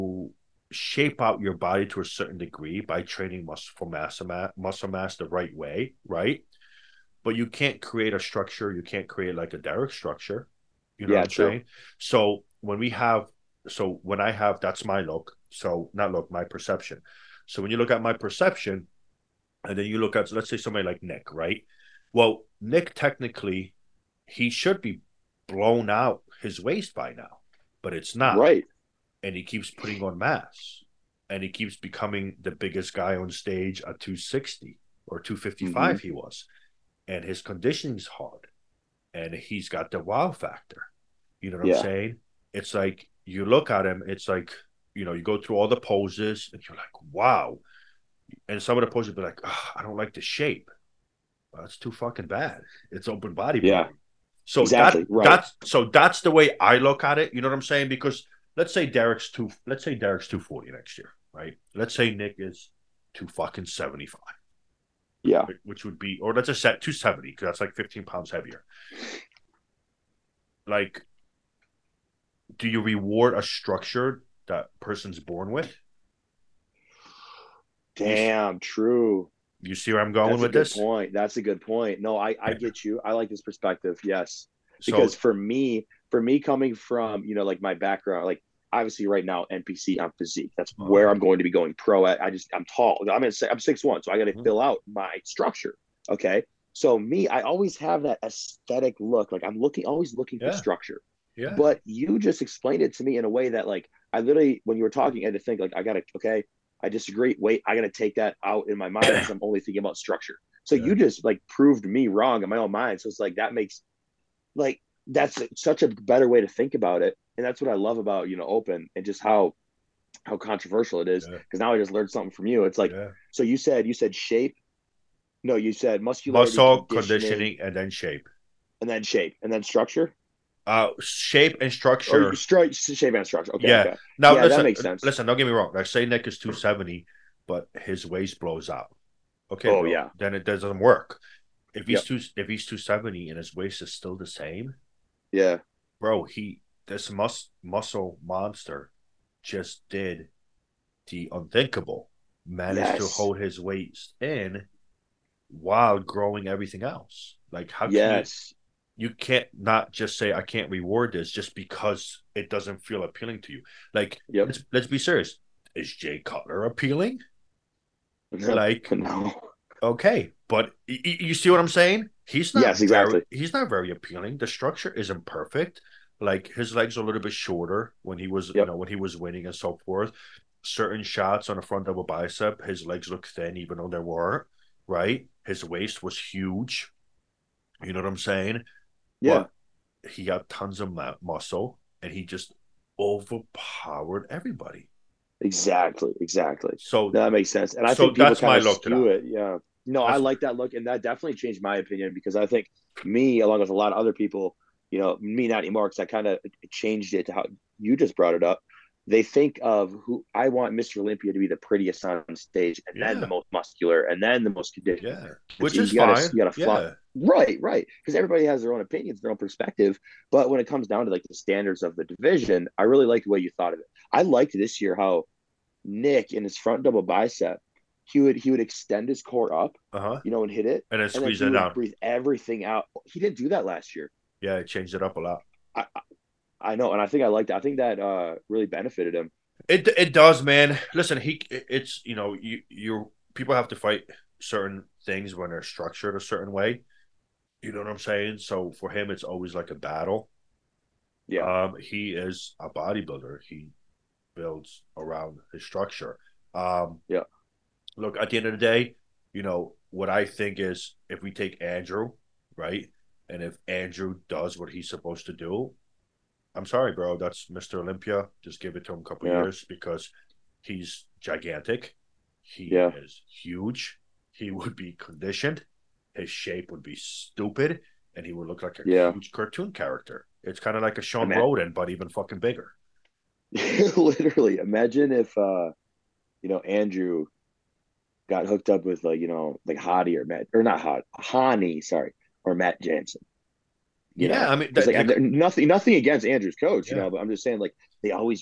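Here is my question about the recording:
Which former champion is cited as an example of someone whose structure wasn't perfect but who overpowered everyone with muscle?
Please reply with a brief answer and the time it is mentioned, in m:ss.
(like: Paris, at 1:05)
Jay Cutler, at 2:45.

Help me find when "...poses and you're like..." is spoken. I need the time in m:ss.
0:45.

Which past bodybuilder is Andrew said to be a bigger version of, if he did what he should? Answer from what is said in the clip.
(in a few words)
Shawn Rhoden.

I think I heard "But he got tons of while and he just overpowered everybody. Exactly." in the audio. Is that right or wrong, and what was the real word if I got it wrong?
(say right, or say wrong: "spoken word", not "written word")
wrong: "muscle", not "while".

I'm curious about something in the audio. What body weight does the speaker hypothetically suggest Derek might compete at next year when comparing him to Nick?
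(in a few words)
240.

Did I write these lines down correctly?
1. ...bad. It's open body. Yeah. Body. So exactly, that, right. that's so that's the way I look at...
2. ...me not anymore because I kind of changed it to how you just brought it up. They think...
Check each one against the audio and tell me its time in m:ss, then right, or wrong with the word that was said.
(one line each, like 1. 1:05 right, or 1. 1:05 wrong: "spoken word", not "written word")
1. 0:52 right
2. 3:25 right.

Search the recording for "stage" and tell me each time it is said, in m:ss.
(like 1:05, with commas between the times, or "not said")
0:33, 3:32.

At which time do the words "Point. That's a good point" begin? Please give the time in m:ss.
1:20.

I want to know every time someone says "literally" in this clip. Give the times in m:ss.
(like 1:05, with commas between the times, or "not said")
1:44, 4:43.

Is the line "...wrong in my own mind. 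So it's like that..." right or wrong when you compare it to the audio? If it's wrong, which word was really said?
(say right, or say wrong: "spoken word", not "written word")
right.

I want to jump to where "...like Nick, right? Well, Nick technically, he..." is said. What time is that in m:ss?
0:20.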